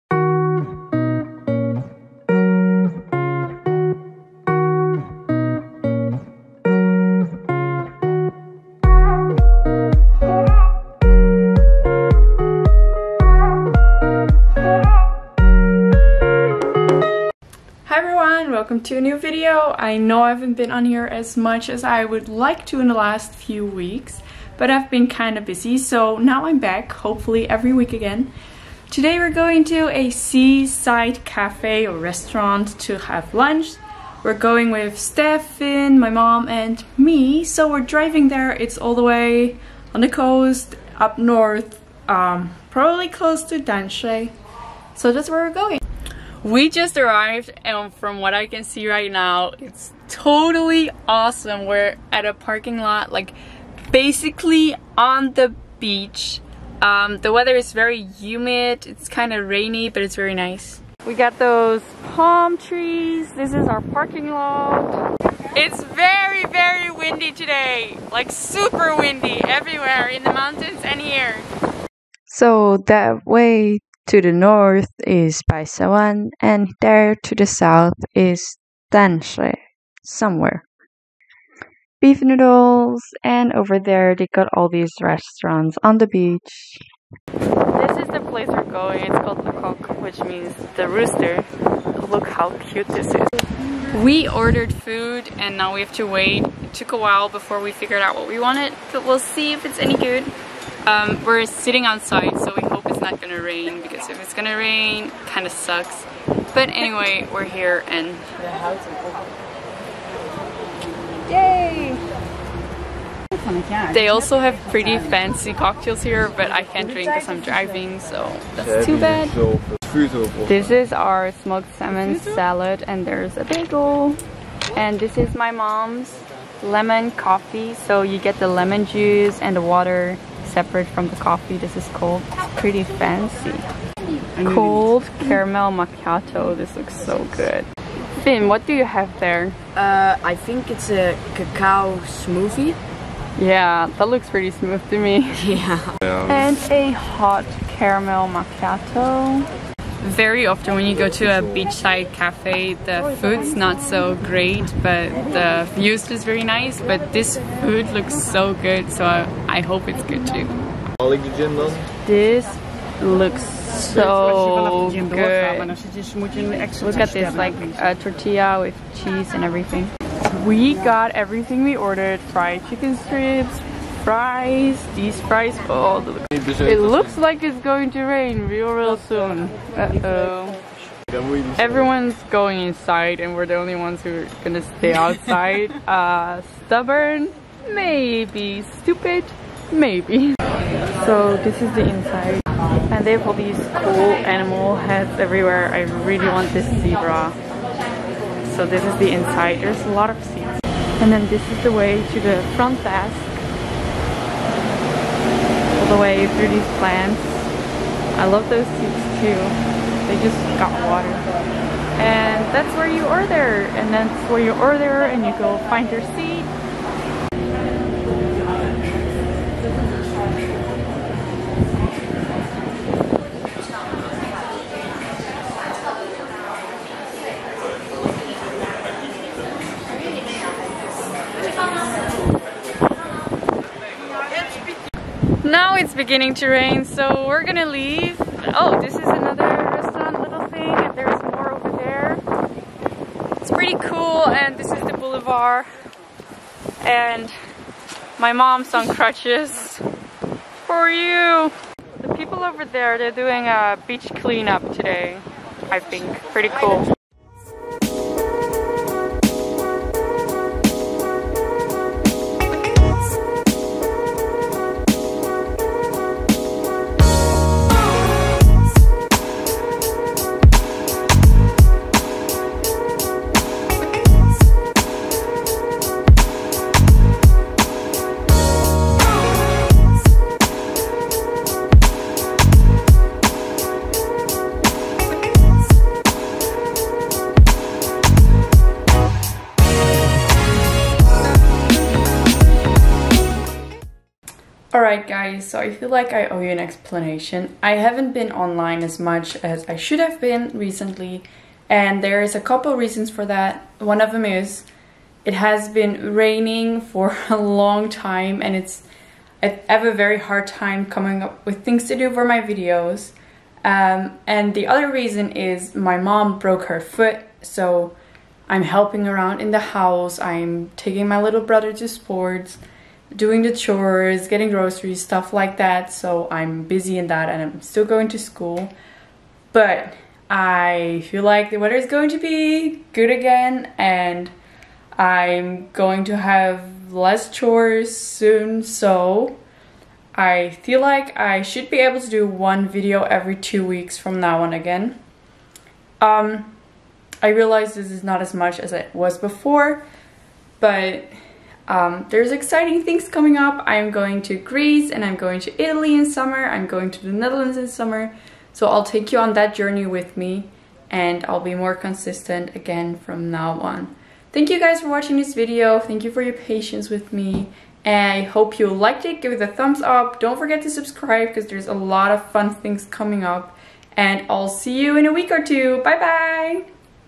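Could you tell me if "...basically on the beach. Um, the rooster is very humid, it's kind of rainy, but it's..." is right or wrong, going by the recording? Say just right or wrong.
wrong.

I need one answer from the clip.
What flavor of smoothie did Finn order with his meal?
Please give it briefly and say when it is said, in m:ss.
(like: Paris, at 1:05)
Cacao, at 2:21.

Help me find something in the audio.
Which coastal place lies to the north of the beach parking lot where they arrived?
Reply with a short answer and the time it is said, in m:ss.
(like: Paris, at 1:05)
Baishawan, at 1:15.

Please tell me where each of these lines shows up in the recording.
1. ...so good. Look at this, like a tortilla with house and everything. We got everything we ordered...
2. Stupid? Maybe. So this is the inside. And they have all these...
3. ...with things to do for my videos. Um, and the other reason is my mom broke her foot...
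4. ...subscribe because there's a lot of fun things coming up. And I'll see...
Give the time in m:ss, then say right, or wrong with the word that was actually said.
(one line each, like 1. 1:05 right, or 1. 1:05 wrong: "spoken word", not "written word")
1. 2:43 wrong: "cheese", not "house"
2. 3:08 right
3. 5:11 right
4. 6:10 right.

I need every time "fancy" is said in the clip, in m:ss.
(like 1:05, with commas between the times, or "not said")
1:54, 2:12.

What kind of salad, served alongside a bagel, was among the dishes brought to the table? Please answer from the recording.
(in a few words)
Smoked salmon.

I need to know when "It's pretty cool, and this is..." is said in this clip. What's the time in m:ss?
4:03.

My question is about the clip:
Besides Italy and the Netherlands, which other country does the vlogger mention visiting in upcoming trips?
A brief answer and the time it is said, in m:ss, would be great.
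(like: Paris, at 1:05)
Greece, at 5:54.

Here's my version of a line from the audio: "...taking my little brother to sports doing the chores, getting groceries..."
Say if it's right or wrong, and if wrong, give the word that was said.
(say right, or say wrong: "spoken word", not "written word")
right.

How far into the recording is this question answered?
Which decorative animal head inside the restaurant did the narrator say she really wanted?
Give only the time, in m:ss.
3:16.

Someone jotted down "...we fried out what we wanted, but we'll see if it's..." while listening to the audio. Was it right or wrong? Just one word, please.
wrong.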